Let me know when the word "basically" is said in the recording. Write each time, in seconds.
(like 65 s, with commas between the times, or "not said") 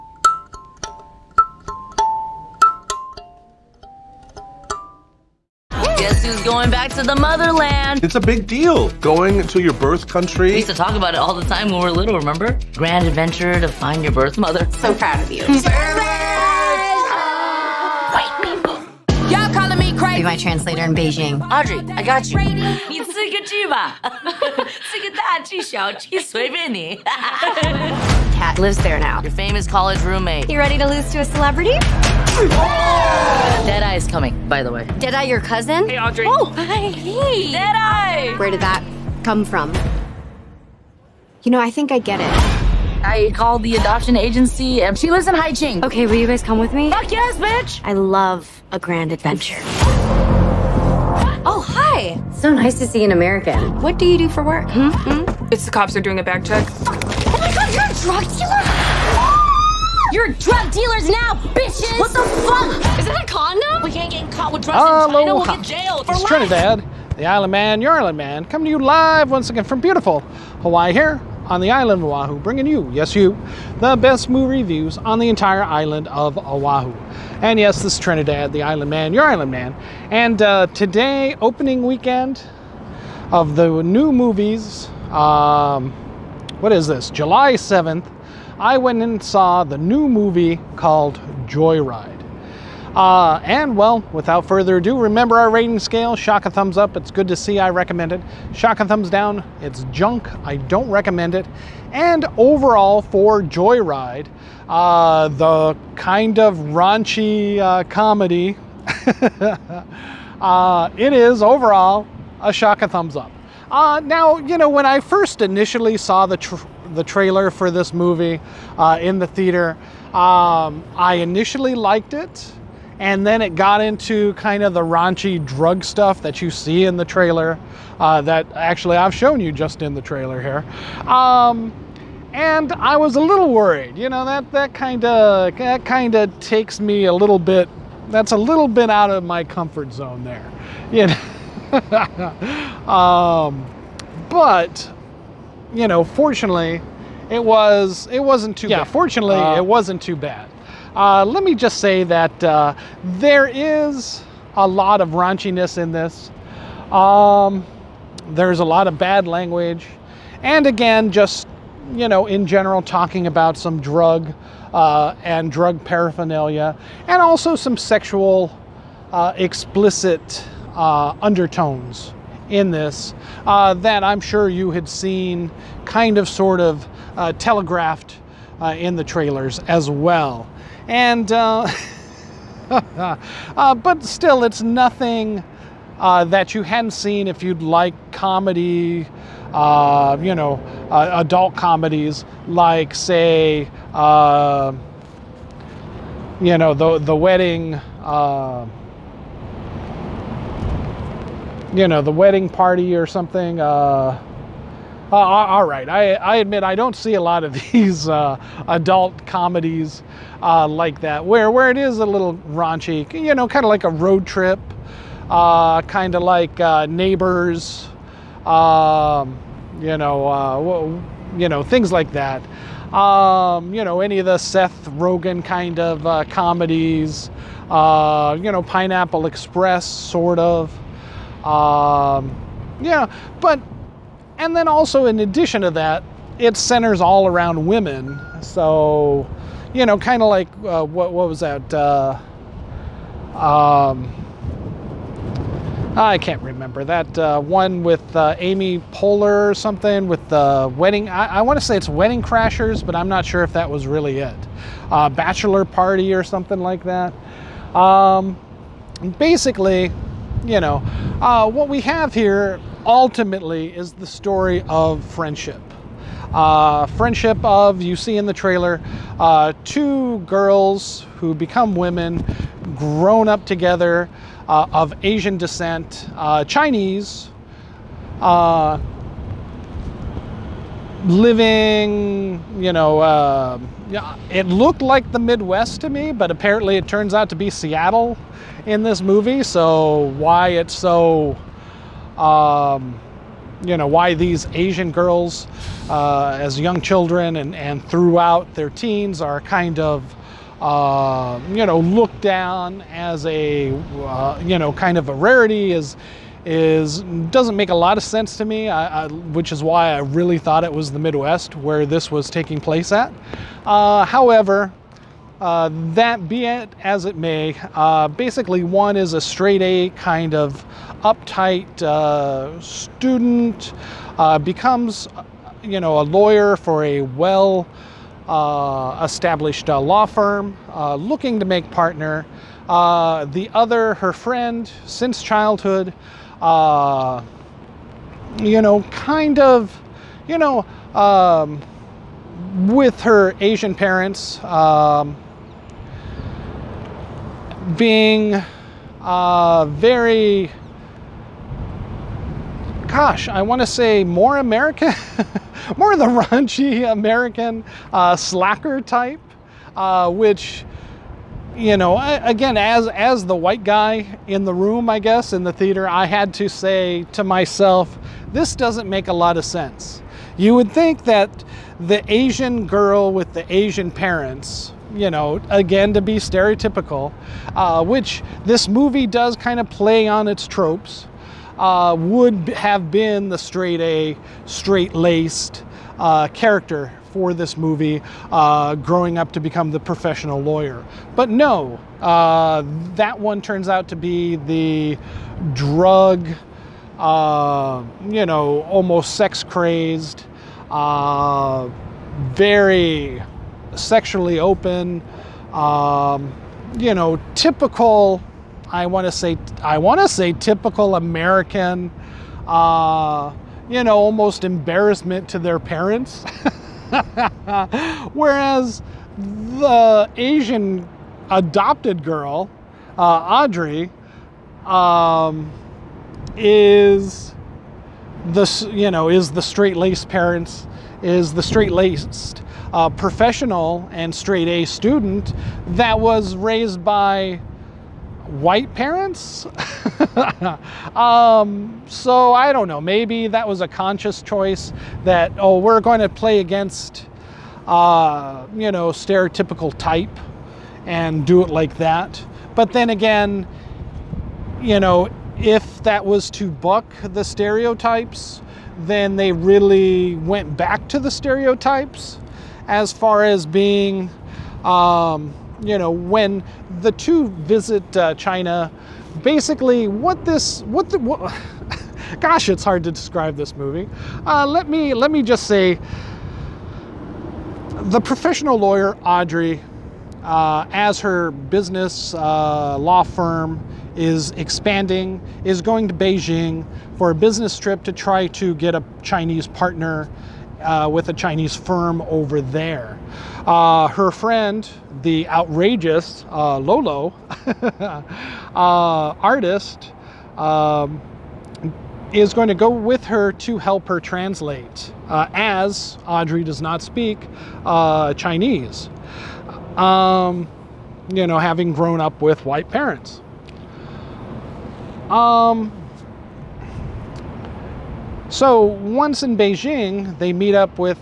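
259 s, 318 s, 469 s.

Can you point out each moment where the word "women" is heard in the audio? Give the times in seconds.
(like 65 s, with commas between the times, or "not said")
237 s, 271 s.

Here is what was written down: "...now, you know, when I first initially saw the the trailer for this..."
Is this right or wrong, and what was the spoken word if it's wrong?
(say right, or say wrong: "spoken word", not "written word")
right.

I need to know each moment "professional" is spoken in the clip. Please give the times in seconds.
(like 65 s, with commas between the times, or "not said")
389 s, 432 s, 477 s.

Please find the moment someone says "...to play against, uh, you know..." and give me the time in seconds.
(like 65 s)
445 s.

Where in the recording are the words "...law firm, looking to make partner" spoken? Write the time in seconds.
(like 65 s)
329 s.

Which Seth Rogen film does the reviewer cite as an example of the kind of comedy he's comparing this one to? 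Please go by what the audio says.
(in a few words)
Pineapple Express.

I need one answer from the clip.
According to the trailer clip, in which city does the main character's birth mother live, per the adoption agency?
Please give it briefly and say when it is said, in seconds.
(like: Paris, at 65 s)
Haicheng, at 45 s.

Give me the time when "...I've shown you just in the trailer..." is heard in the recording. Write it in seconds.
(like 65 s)
128 s.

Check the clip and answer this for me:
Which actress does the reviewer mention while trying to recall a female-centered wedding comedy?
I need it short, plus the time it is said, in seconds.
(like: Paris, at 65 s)
Amy Poehler, at 248 s.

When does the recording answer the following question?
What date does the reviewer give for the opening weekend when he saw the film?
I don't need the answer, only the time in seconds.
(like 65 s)
87 s.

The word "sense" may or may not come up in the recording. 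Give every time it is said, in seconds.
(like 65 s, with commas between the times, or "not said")
308 s, 369 s.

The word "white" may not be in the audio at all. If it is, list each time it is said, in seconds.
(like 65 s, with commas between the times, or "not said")
363 s, 438 s, 512 s.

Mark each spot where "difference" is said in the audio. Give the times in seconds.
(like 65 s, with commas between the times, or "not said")
not said.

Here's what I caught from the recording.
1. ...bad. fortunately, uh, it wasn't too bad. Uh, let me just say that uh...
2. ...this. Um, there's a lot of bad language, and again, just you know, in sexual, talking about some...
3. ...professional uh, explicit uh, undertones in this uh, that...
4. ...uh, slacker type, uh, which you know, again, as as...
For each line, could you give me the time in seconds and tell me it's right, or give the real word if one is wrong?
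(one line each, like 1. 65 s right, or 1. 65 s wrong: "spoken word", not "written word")
1. 148 s right
2. 155 s wrong: "general", not "sexual"
3. 167 s wrong: "sexual", not "professional"
4. 357 s right.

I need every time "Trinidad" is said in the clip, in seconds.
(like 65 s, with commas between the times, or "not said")
66 s, 77 s.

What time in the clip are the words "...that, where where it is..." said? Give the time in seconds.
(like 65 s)
210 s.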